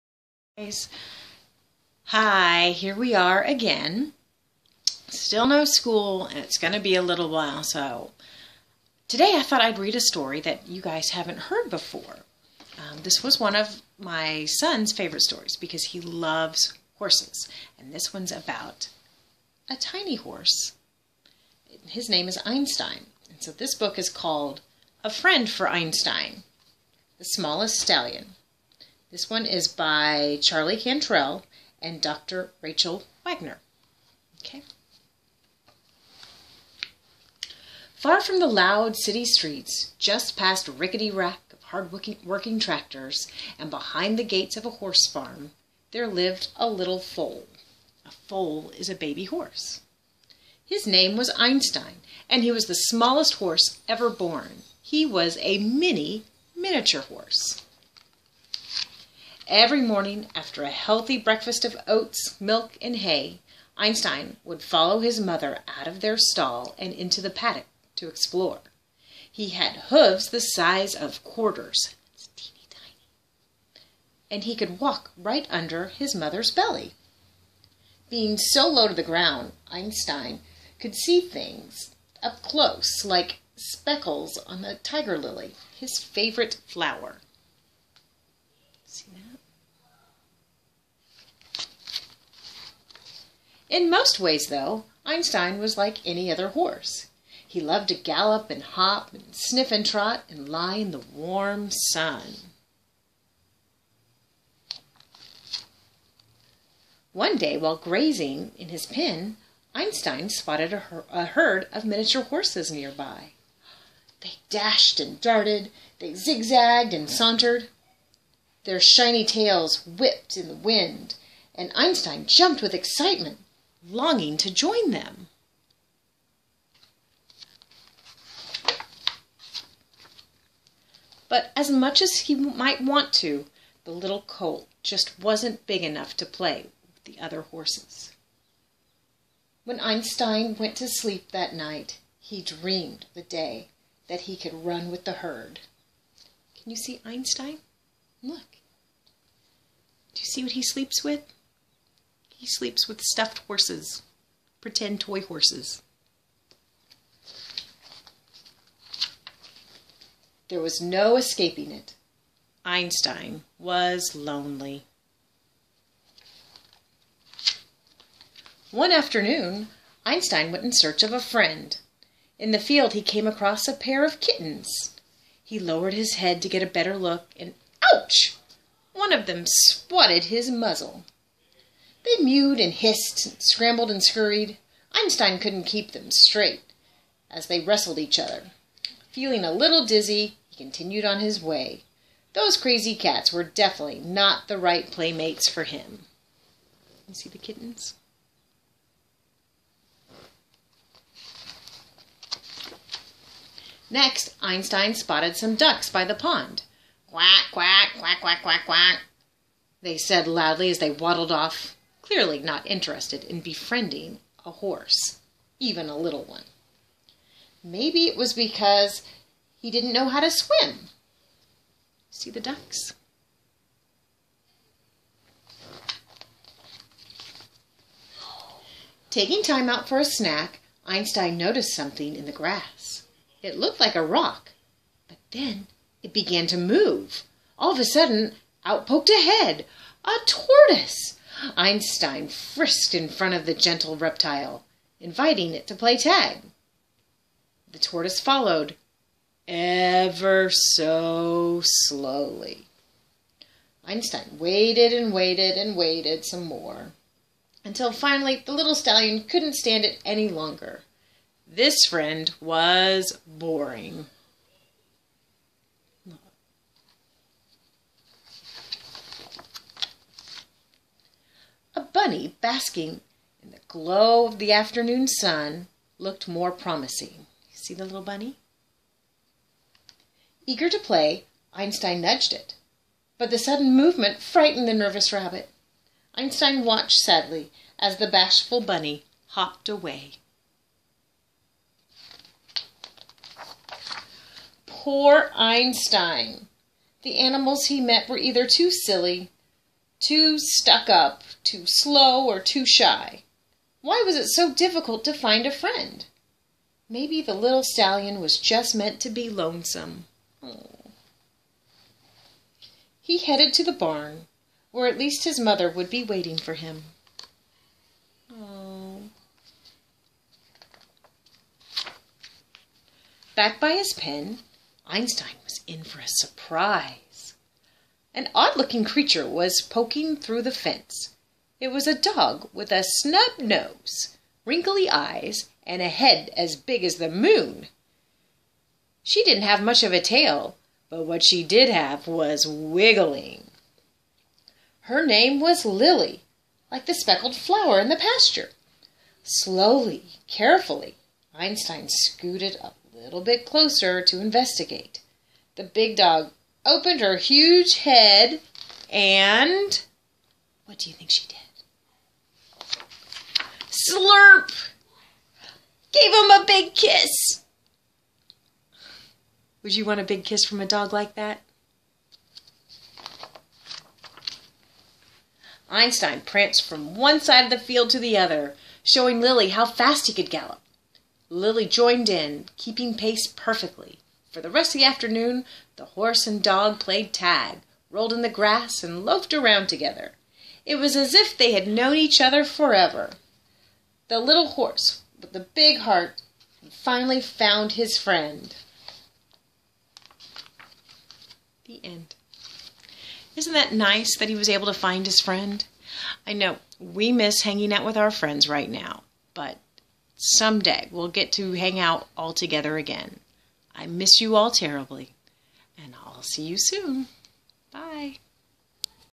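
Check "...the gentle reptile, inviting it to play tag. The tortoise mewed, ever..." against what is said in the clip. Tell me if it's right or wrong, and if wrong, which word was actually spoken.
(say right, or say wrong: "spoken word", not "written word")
wrong: "followed", not "mewed".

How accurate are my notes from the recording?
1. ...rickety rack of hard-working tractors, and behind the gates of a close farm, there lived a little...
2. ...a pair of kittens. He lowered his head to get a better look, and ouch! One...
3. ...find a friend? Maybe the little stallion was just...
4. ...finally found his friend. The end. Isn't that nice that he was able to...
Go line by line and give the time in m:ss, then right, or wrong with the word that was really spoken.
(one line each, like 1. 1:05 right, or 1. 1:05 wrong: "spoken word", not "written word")
1. 0:40 wrong: "horse", not "close"
2. 2:53 right
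3. 5:05 right
4. 6:36 right.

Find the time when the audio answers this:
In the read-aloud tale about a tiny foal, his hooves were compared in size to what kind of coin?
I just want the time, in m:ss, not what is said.
1:11.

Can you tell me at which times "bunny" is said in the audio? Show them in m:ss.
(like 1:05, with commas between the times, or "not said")
4:31, 4:38, 4:48.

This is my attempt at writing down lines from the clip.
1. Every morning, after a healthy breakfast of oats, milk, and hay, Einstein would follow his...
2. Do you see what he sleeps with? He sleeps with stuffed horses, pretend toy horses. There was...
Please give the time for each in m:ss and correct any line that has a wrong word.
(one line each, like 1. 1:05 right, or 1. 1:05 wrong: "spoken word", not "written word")
1. 0:59 right
2. 2:30 right.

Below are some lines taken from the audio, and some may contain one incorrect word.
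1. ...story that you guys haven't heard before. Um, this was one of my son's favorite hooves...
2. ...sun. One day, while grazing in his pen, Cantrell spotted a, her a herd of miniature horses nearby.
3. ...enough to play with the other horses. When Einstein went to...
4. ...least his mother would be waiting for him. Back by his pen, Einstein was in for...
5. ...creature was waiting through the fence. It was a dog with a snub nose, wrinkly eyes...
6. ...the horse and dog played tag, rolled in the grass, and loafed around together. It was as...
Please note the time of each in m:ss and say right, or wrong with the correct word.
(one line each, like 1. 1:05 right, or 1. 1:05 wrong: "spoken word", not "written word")
1. 0:10 wrong: "stories", not "hooves"
2. 1:41 wrong: "Einstein", not "Cantrell"
3. 2:15 right
4. 5:14 right
5. 5:28 wrong: "poking", not "waiting"
6. 6:25 right.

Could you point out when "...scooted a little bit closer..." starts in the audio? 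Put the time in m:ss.
5:51.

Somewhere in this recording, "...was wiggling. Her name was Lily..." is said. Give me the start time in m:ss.
5:42.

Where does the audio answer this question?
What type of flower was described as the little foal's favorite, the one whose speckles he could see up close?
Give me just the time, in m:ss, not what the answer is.
1:24.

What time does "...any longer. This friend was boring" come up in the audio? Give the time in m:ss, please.
4:20.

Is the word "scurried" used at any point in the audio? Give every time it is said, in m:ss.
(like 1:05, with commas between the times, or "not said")
3:04.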